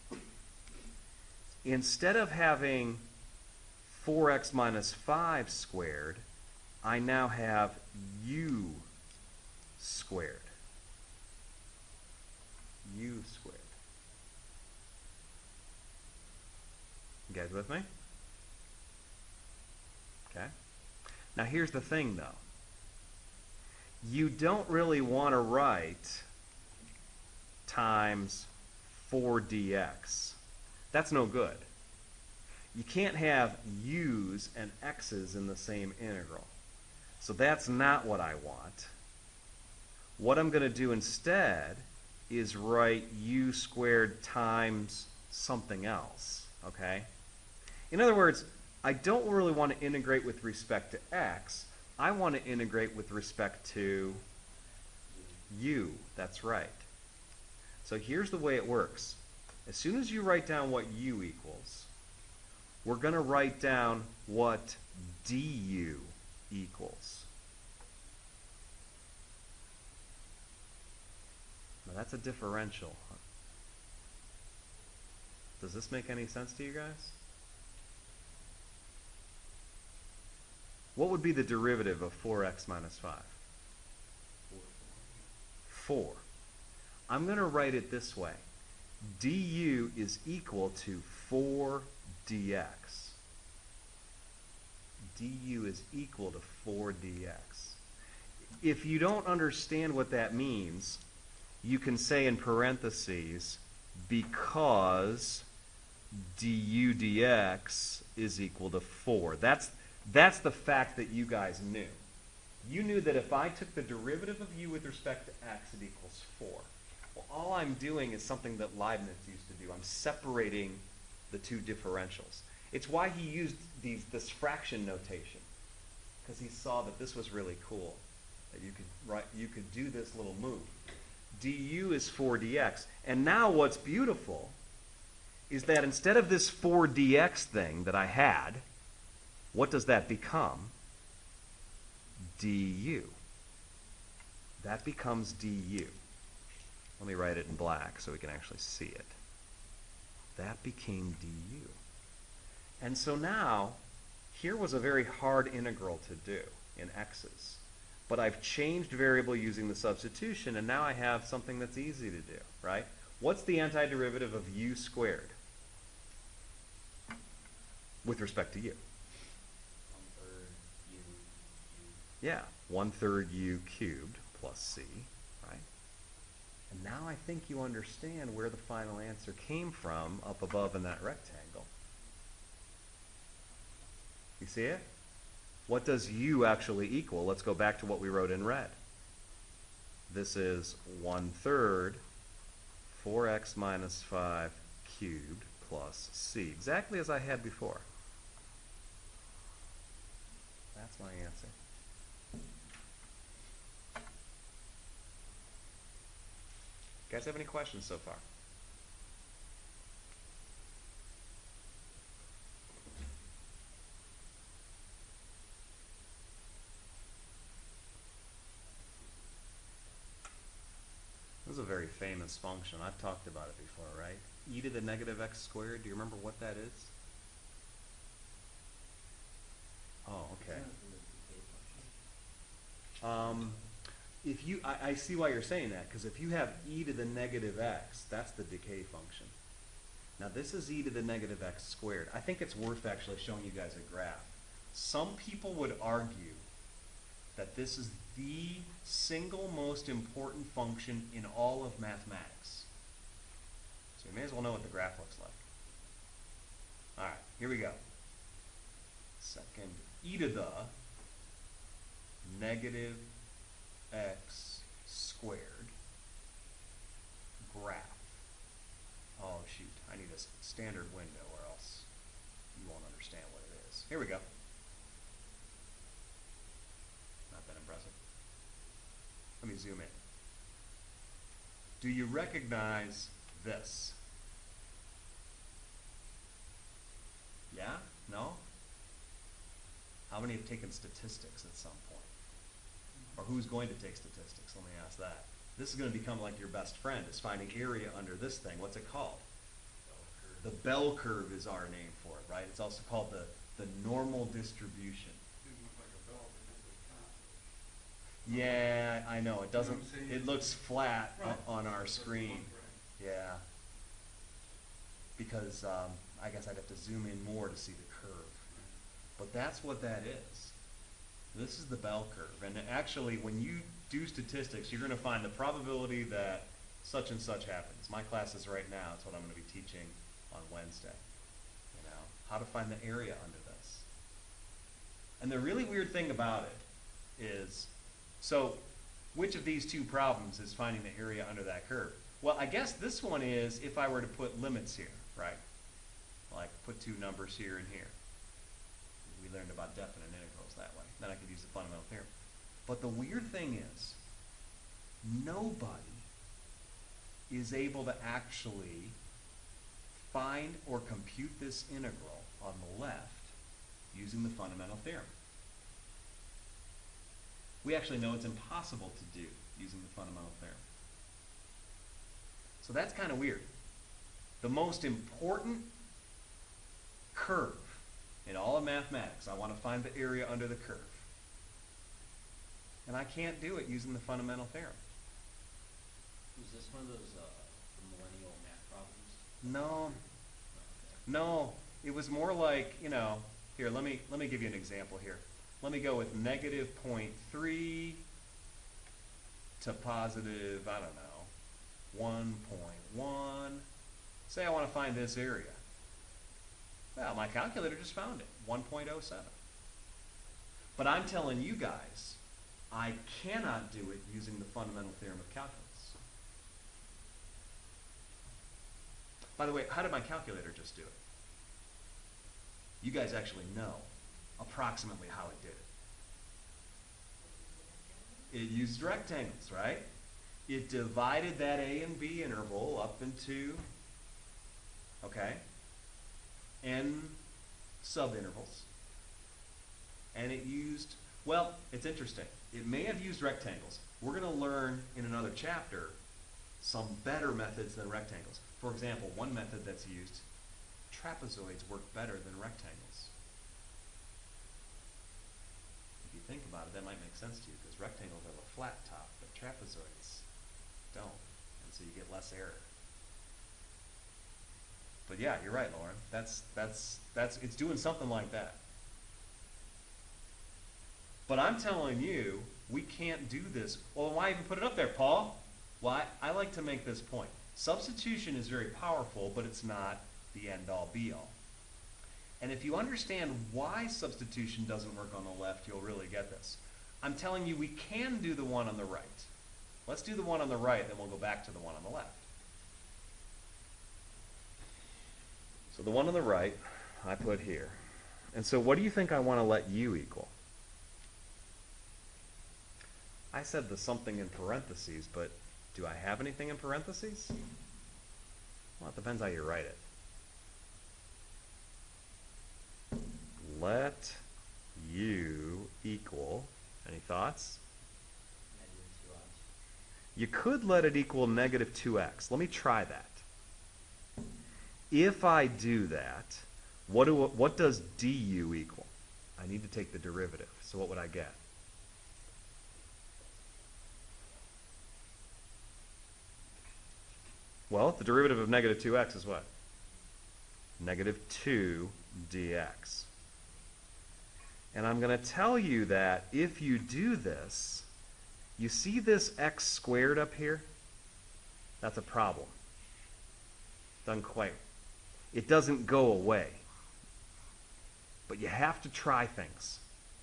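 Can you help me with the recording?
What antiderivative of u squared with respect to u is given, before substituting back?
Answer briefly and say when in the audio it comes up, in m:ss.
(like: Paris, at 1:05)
1/3 u cubed plus c, at 2:52.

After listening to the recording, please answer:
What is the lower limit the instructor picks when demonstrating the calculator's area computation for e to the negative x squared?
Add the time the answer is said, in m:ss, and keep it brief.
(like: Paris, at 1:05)
-0.3, at 6:36.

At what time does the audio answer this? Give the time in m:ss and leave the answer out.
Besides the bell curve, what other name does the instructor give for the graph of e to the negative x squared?
5:03.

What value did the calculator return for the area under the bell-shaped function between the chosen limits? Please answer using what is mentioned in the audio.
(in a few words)
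1.07.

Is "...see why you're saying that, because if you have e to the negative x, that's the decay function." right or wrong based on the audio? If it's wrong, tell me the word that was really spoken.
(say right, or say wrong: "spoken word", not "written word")
right.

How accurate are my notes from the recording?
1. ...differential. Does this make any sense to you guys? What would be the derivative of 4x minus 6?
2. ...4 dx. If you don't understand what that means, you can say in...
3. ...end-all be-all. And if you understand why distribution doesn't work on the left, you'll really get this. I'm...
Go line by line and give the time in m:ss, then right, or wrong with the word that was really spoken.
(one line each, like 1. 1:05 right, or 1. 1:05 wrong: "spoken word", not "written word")
1. 1:12 wrong: "5", not "6"
2. 1:36 right
3. 8:00 wrong: "substitution", not "distribution".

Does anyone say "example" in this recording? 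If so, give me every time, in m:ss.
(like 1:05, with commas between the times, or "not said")
6:34, 7:28.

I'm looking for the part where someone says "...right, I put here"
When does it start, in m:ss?
8:16.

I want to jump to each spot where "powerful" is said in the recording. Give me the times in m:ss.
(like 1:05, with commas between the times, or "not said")
7:58.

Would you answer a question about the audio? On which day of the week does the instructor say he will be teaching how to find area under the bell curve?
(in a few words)
Wednesday.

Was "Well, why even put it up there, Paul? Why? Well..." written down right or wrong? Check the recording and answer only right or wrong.
right.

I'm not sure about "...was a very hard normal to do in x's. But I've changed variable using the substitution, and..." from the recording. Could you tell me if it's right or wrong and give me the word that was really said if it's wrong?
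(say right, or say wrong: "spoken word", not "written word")
wrong: "integral", not "normal".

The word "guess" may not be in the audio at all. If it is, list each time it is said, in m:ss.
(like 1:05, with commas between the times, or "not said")
5:16, 5:42.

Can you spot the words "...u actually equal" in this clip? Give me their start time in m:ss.
3:06.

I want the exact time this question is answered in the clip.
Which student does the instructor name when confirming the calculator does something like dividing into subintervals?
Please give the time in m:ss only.
7:45.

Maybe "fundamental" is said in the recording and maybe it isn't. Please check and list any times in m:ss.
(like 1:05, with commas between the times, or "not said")
5:51, 6:04, 6:09, 6:23, 6:54.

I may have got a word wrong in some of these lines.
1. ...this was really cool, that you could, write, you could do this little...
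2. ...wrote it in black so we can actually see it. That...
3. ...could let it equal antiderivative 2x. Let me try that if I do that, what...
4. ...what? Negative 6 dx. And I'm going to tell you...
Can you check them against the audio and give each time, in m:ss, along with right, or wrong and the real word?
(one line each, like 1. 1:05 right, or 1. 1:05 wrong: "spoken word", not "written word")
1. 2:06 right
2. 2:27 wrong: "write", not "wrote"
3. 8:40 wrong: "negative", not "antiderivative"
4. 8:59 wrong: "2", not "6".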